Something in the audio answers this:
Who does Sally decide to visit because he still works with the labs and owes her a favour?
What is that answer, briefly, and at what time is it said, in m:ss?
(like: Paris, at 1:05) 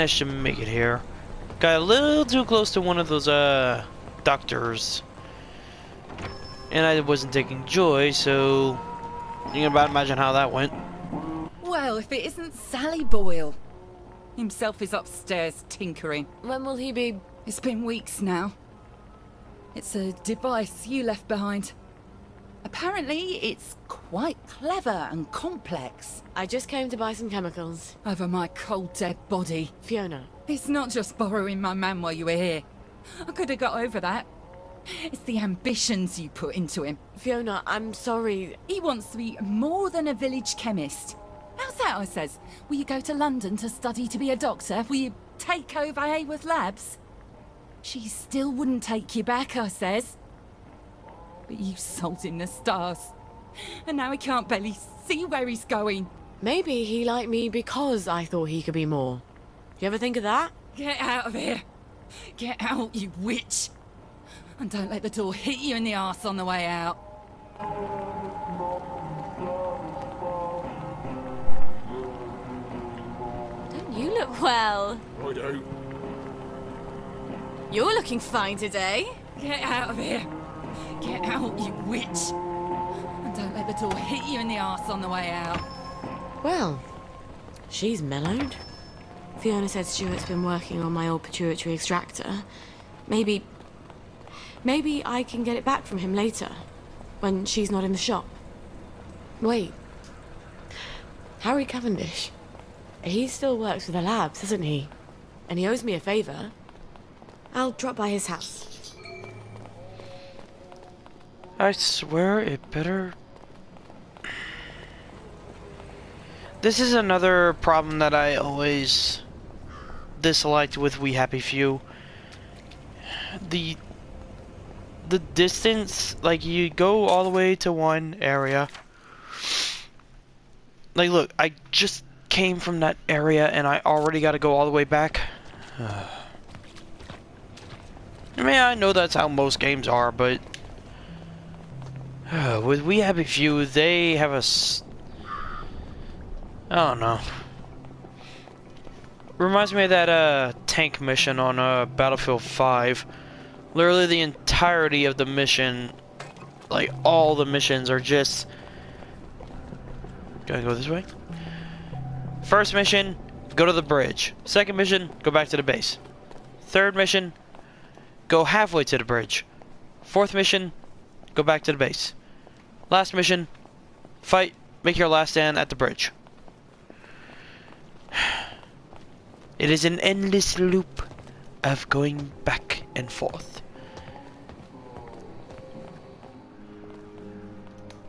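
Harry Cavendish, at 1:41.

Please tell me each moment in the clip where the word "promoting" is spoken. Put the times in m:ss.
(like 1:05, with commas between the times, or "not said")
not said.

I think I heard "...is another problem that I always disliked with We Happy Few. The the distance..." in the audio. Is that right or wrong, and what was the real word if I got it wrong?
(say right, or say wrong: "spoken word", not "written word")
right.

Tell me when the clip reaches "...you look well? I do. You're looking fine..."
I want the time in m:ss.
1:13.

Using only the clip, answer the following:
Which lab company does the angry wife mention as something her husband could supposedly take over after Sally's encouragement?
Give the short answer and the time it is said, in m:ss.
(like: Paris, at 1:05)
Haworth Labs, at 0:46.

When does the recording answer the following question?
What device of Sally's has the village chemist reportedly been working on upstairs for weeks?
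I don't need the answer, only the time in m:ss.
1:31.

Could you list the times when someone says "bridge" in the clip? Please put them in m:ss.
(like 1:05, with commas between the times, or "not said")
2:43, 2:49, 2:55.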